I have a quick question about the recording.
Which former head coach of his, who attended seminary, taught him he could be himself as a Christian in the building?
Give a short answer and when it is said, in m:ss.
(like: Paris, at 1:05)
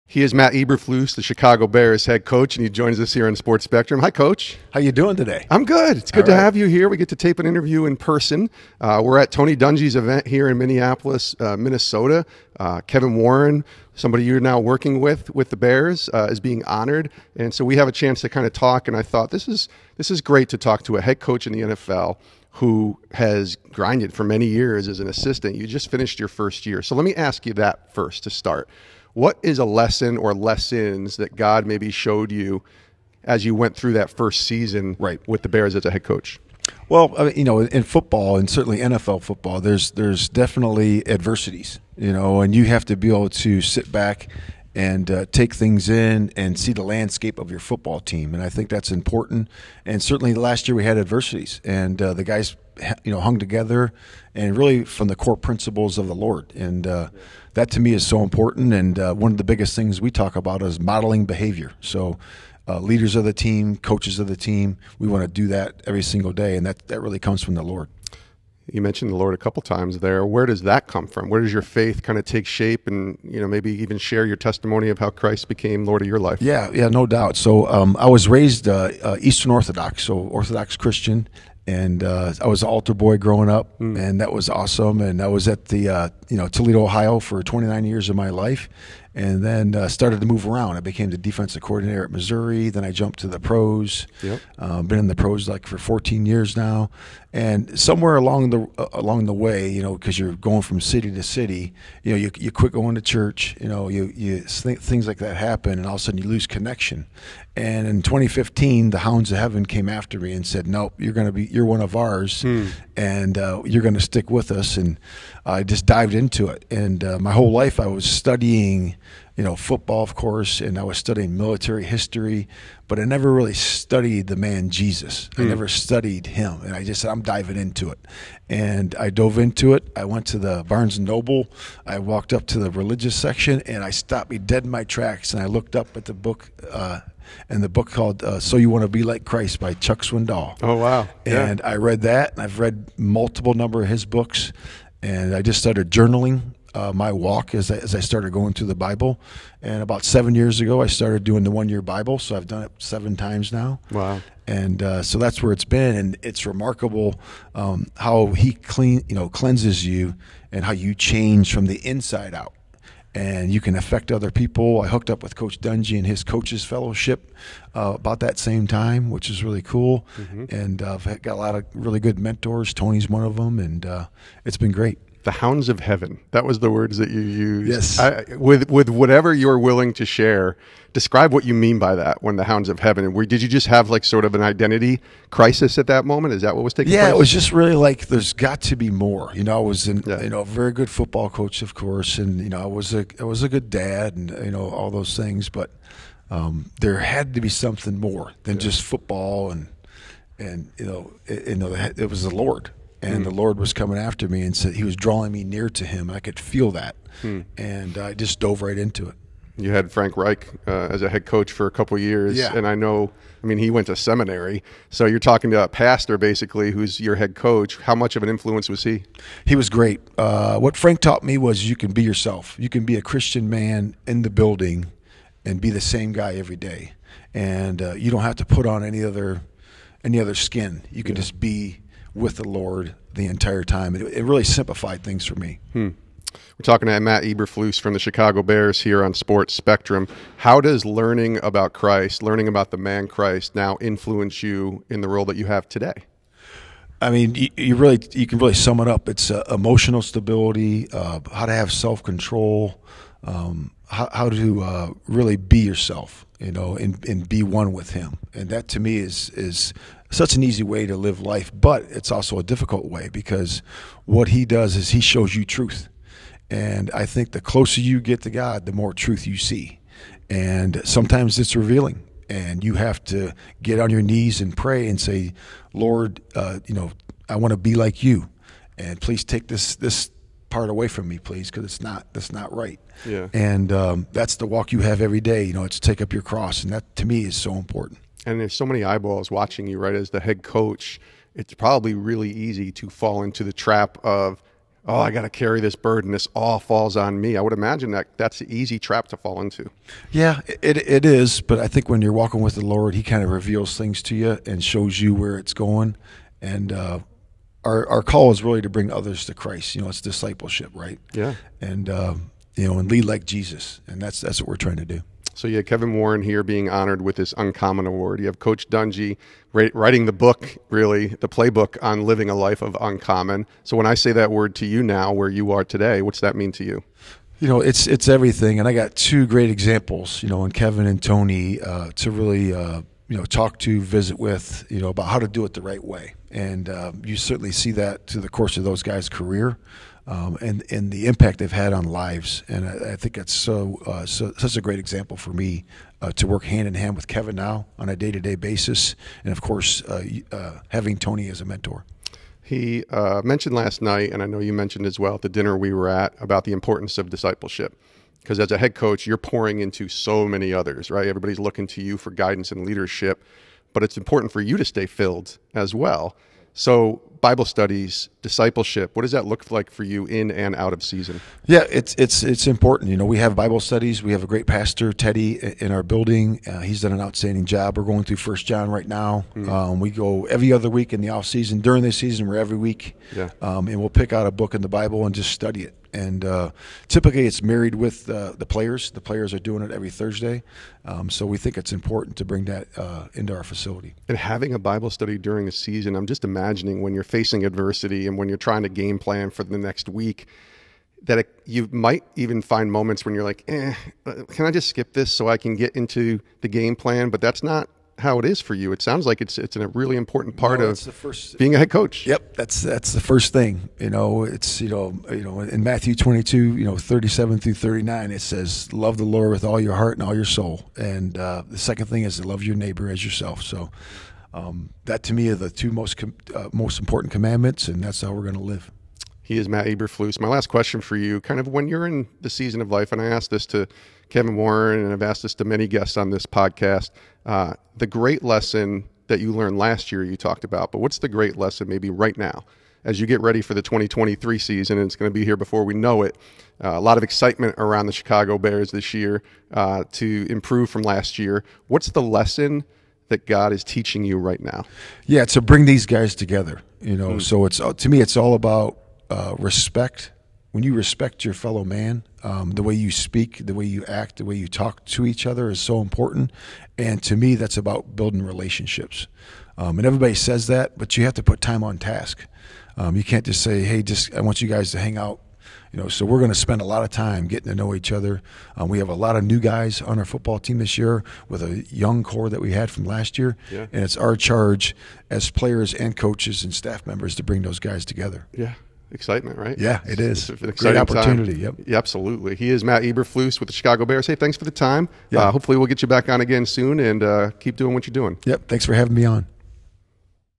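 Frank Reich, at 3:29.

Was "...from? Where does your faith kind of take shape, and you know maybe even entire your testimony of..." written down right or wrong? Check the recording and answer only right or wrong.
wrong.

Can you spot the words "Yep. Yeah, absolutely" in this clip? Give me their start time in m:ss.
8:11.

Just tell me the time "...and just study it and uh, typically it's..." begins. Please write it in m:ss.
6:25.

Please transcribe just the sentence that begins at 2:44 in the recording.
I hooked up with Coach Dungy and his coaches fellowship uh, about that same time, which is really cool.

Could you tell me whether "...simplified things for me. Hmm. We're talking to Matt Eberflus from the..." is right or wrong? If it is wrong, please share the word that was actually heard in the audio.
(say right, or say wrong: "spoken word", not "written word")
right.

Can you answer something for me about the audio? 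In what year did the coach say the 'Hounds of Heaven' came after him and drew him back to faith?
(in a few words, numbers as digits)
2015.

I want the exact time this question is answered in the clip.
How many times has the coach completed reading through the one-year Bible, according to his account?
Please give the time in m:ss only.
2:32.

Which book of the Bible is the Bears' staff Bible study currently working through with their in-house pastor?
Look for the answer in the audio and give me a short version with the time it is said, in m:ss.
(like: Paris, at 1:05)
First John, at 6:18.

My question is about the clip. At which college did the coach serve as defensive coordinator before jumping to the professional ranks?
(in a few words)
Missouri.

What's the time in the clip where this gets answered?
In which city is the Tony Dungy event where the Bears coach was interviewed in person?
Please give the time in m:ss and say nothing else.
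0:10.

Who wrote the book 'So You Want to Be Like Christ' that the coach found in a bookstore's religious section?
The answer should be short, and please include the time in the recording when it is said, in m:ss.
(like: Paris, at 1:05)
Chuck Swindoll, at 2:19.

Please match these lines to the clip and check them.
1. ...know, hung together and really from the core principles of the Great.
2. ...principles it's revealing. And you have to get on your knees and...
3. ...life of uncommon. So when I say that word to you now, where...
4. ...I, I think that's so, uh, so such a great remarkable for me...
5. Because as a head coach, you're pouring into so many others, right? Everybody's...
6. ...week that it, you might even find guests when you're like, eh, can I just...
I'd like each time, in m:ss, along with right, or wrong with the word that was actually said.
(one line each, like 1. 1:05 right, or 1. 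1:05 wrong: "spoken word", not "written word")
1. 0:53 wrong: "Lord", not "Great"
2. 4:30 wrong: "sometimes", not "principles"
3. 5:22 right
4. 5:42 wrong: "example", not "remarkable"
5. 5:58 right
6. 6:39 wrong: "moments", not "guests".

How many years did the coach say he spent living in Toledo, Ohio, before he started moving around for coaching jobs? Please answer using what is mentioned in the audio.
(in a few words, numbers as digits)
29.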